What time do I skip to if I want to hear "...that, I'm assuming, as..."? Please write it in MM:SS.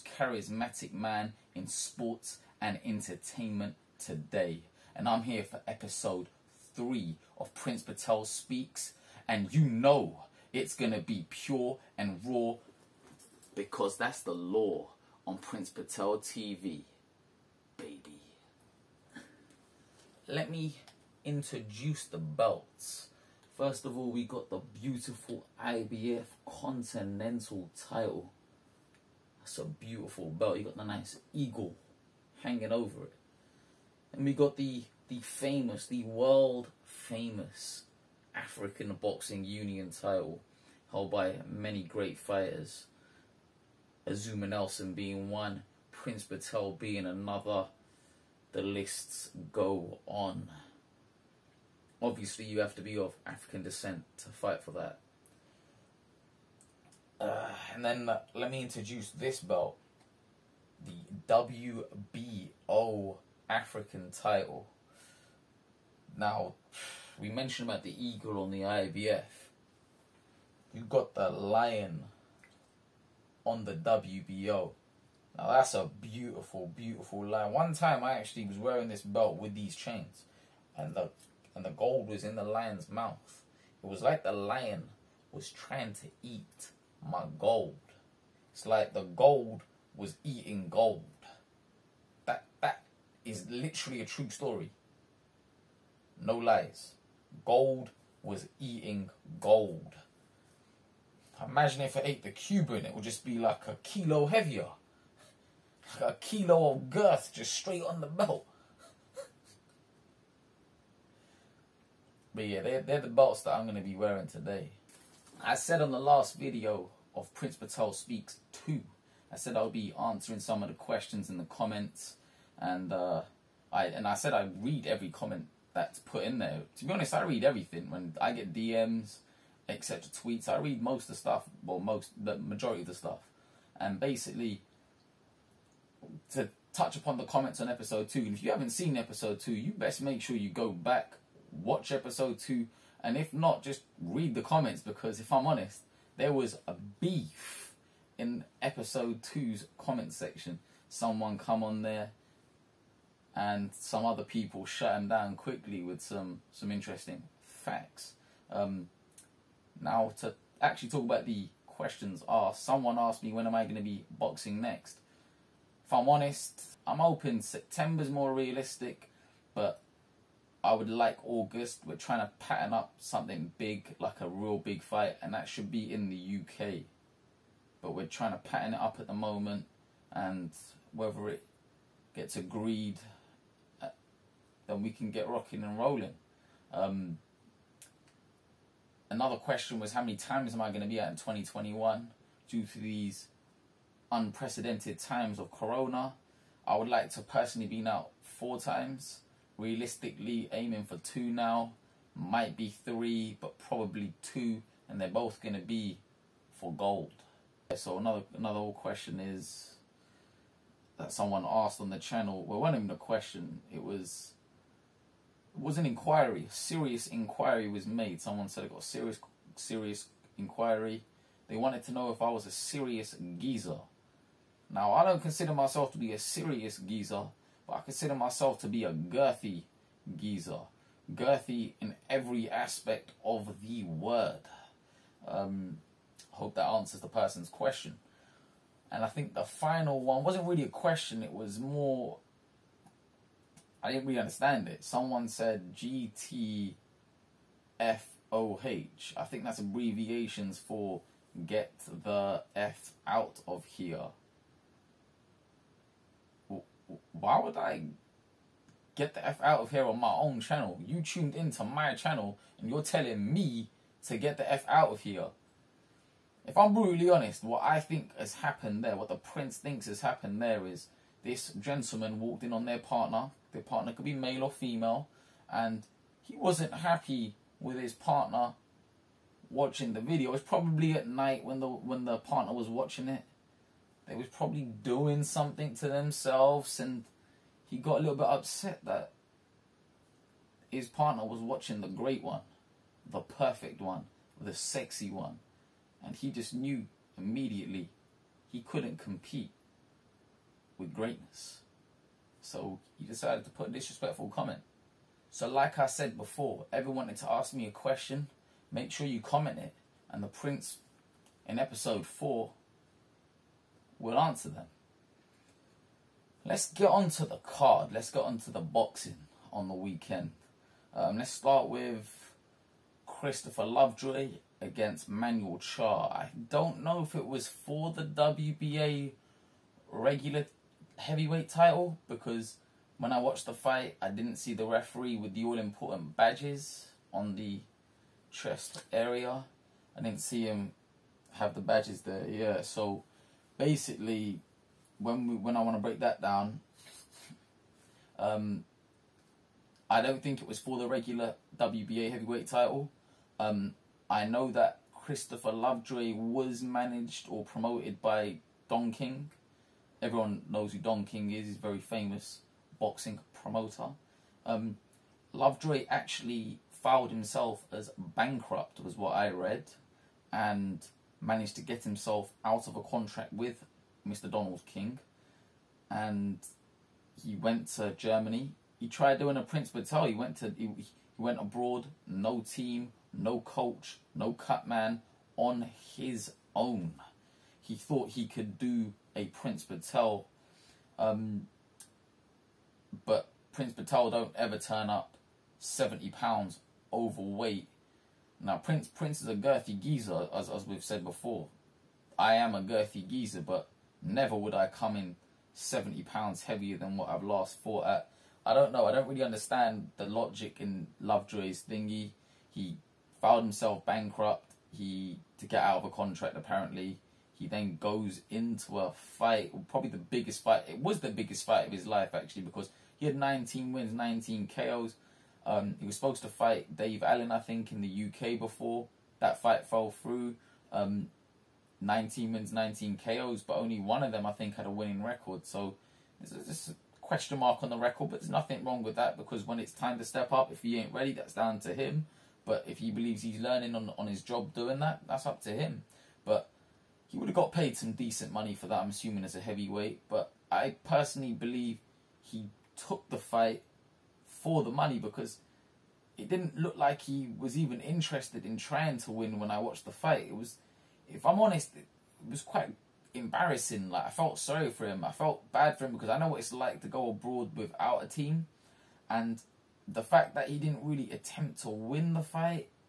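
07:28.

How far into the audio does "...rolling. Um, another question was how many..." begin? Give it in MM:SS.
03:05.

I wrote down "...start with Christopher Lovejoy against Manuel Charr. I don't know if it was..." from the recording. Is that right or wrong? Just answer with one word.
right.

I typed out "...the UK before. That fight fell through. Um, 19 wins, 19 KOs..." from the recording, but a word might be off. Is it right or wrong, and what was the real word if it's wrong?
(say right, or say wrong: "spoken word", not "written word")
right.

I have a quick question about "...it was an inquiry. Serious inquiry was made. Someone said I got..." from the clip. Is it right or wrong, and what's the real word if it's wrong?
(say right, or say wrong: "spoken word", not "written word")
right.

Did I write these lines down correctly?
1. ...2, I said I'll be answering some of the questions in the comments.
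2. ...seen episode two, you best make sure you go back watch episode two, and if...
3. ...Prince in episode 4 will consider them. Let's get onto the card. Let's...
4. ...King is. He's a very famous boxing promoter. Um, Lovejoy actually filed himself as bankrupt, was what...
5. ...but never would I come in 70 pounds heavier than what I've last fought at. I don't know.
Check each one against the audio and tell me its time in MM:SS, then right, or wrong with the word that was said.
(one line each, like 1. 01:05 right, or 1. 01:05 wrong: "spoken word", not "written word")
1. 01:58 right
2. 02:18 right
3. 05:10 wrong: "answer", not "consider"
4. 06:01 right
5. 06:43 right.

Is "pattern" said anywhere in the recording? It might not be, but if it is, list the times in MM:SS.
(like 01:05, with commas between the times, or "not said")
02:52, 02:58.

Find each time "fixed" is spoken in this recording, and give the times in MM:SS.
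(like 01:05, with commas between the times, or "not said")
not said.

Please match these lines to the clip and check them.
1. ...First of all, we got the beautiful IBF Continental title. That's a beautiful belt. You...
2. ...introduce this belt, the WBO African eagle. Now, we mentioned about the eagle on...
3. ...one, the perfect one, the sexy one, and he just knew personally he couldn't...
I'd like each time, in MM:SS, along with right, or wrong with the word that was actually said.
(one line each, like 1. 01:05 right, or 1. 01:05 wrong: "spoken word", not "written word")
1. 00:23 right
2. 00:58 wrong: "title", not "eagle"
3. 04:52 wrong: "immediately", not "personally".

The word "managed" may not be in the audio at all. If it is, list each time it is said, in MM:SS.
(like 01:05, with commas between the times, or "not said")
05:56, 06:11.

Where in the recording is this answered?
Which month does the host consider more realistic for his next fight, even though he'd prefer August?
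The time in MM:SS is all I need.
02:47.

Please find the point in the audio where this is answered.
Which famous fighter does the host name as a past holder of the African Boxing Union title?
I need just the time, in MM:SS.
00:44.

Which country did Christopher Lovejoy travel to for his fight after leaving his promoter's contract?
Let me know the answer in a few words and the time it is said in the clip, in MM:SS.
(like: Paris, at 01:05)
Germany, at 06:17.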